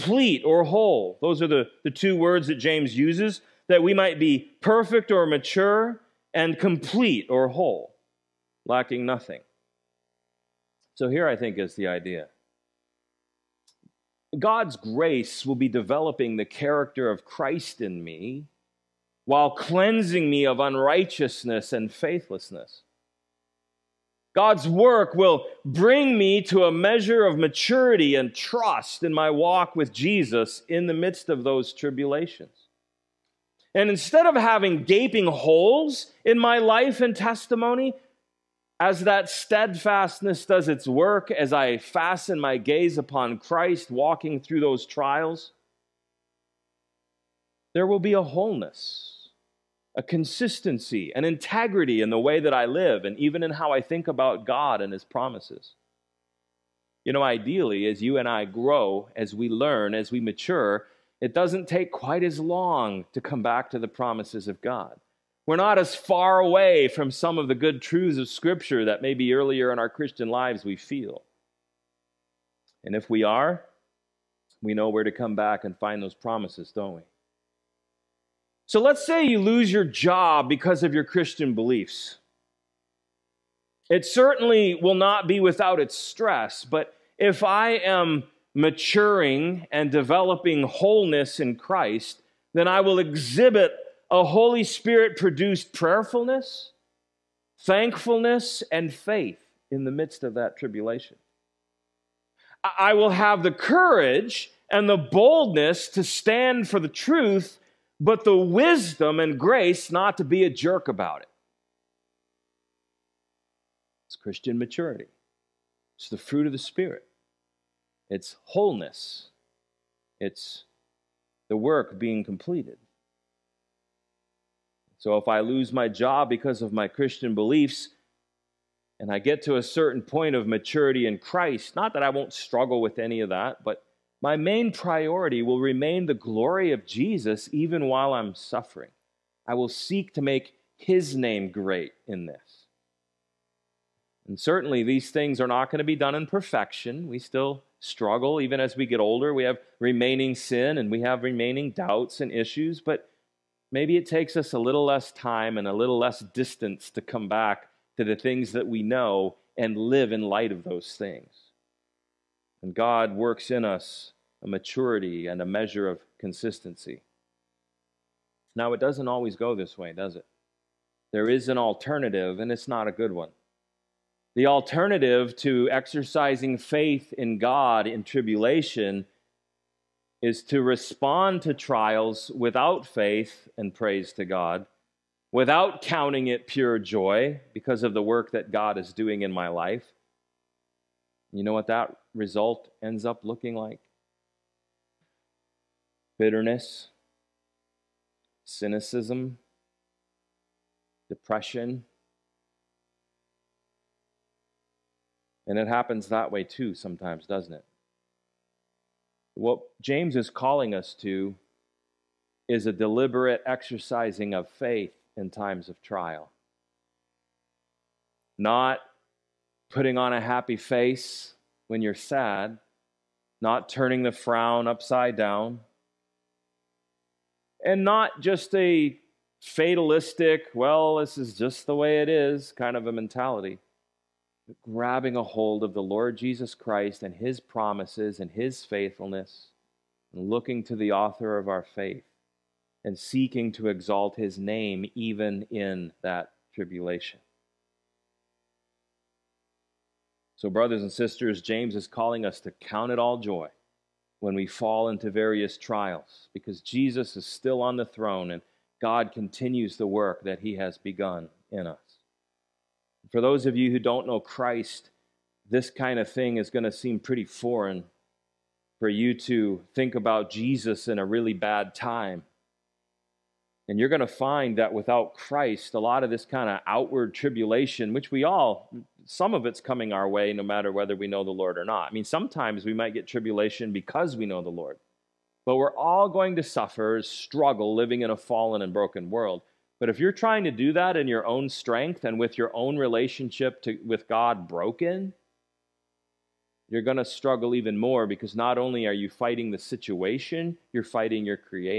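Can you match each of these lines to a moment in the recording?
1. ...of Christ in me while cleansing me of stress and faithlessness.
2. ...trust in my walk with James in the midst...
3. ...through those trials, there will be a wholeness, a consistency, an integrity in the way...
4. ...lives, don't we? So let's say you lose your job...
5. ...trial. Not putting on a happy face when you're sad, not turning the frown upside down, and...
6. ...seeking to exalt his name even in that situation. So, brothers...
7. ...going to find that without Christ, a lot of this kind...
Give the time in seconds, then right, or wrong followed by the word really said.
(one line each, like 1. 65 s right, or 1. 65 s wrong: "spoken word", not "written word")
1. 17 s wrong: "unrighteousness", not "stress"
2. 28 s wrong: "Jesus", not "James"
3. 44 s right
4. 76 s wrong: "promises", not "lives"
5. 215 s right
6. 242 s wrong: "tribulation", not "situation"
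7. 273 s right.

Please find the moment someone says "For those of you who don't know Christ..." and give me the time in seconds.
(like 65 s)
263 s.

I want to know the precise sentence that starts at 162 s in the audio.
And God works in us a maturity and a measure of consistency.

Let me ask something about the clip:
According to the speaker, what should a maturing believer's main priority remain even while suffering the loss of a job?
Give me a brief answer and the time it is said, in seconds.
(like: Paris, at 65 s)
the glory of Jesus, at 136 s.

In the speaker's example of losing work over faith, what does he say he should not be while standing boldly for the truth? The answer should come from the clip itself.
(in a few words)
a jerk.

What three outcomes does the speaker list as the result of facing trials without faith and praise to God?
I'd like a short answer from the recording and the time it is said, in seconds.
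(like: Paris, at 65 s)
Bitterness, cynicism, depression, at 196 s.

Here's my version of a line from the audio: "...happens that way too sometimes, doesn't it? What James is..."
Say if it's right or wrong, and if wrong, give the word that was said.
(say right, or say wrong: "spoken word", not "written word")
right.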